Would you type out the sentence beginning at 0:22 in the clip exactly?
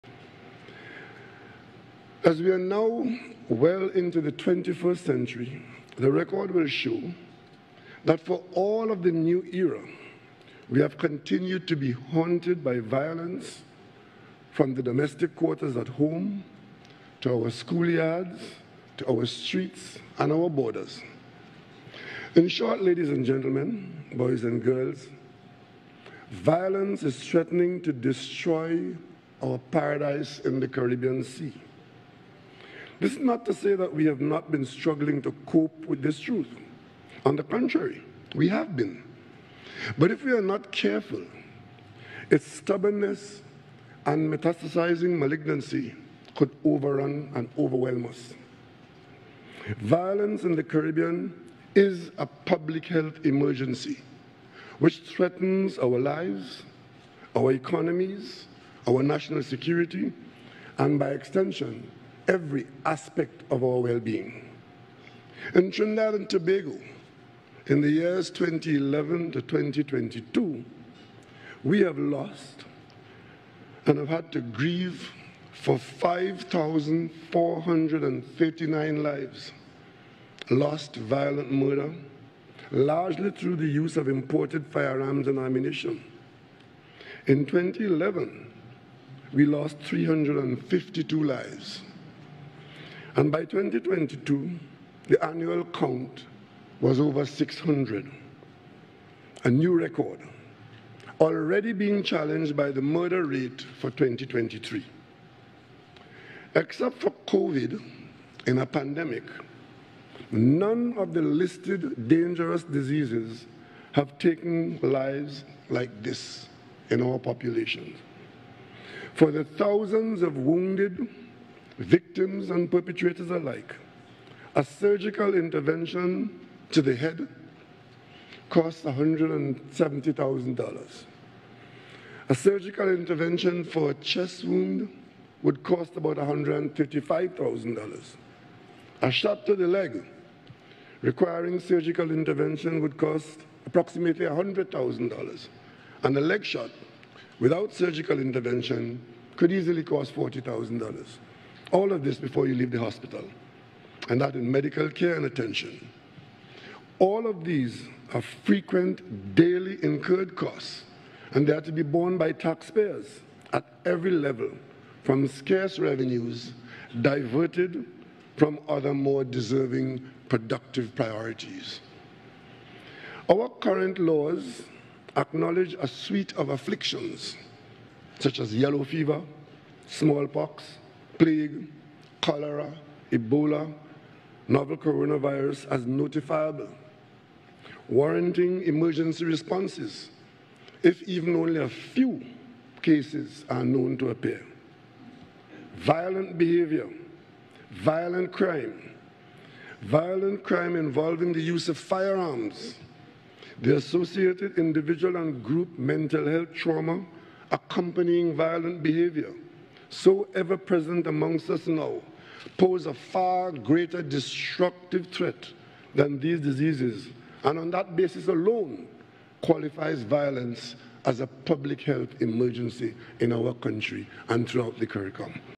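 In short, ladies and gentlemen, boys and girls, violence is threatening to destroy our paradise in the Caribbean Sea.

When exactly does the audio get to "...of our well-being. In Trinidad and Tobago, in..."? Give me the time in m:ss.
1:03.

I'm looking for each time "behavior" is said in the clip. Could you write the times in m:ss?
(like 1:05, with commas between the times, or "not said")
3:16, 3:28.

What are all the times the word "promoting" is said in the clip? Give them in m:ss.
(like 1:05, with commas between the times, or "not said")
not said.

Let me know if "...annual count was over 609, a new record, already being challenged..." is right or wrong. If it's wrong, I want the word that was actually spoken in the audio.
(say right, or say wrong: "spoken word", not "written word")
wrong: "600", not "609".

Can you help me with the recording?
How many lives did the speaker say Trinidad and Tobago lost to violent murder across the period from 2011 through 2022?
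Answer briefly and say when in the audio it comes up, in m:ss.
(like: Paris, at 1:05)
5,439, at 1:15.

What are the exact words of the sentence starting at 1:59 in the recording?
For the thousands of wounded, victims and perpetrators alike, a surgical intervention to the head costs $170,000.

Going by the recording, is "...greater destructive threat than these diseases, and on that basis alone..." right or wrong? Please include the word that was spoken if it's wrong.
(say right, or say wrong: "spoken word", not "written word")
right.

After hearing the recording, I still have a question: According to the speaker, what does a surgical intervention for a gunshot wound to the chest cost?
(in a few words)
$135,000.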